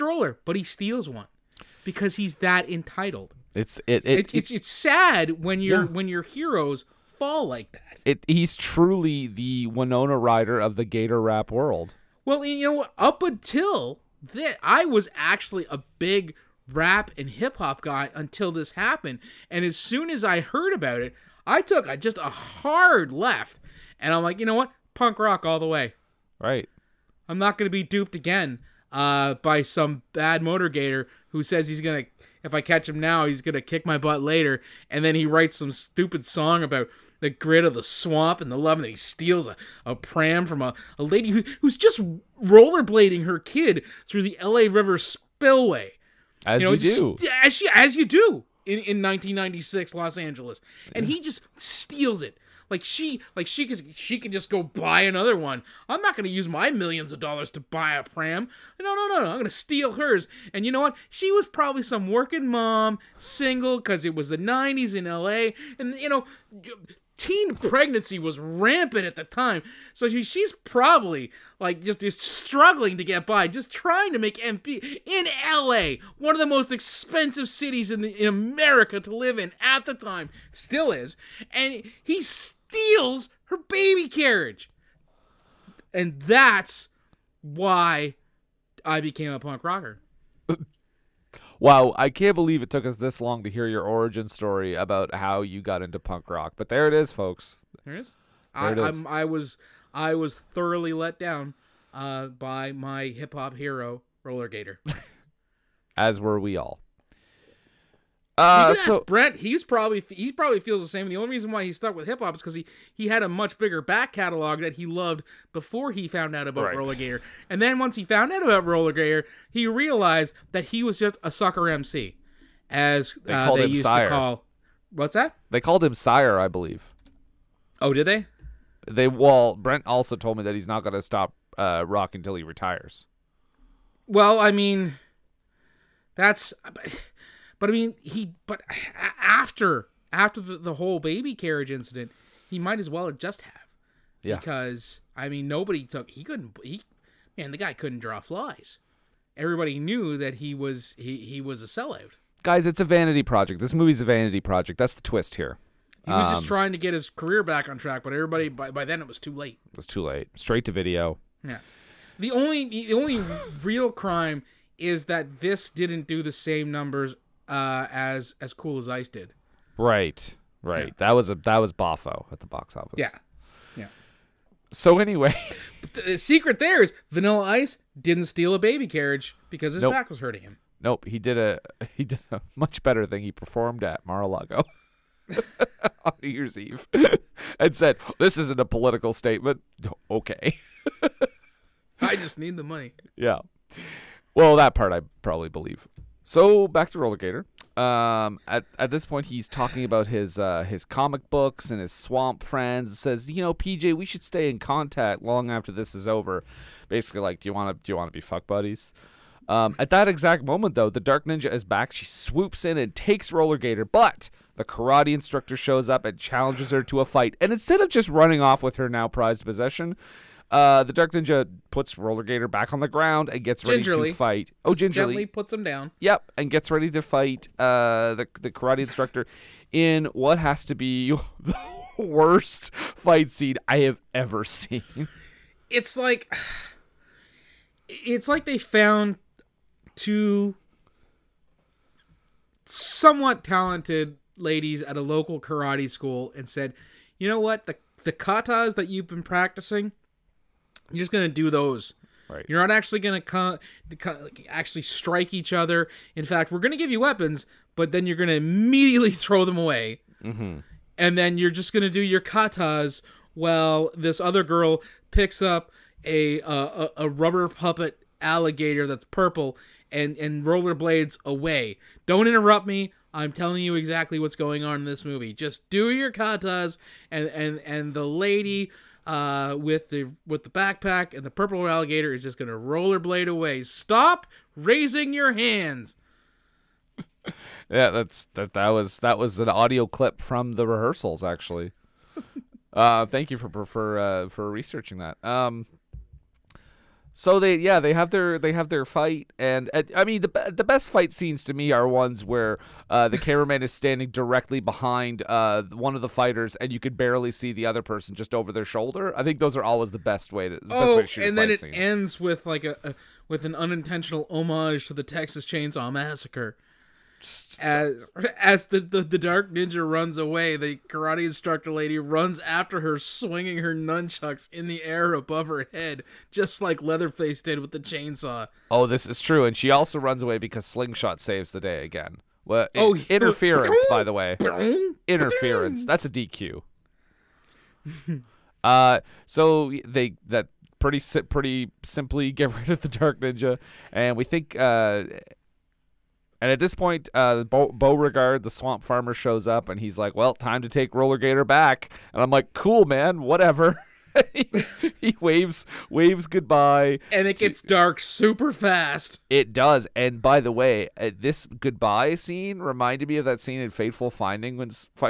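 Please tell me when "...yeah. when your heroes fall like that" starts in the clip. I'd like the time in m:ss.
0:05.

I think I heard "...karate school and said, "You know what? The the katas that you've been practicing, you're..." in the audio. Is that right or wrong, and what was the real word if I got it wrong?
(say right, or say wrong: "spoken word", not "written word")
right.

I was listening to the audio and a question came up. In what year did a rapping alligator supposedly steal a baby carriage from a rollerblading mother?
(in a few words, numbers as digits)
1996.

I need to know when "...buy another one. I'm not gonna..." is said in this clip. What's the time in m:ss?
0:54.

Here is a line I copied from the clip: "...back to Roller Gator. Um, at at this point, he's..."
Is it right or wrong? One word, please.
right.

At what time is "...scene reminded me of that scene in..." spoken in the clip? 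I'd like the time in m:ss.
6:02.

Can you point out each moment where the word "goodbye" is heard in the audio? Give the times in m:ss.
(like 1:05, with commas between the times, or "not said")
5:56, 6:01.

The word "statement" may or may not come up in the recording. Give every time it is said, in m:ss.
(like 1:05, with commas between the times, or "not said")
3:09.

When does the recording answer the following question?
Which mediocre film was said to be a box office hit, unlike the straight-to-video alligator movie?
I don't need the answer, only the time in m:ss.
2:48.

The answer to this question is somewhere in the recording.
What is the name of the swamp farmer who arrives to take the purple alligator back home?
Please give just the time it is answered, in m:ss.
5:47.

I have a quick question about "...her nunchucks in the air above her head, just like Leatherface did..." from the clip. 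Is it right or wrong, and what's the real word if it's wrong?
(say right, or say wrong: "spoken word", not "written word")
right.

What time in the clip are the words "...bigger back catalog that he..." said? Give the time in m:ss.
1:53.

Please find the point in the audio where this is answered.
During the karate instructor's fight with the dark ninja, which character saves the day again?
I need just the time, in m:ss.
5:30.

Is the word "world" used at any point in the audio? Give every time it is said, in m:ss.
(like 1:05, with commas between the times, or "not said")
0:11.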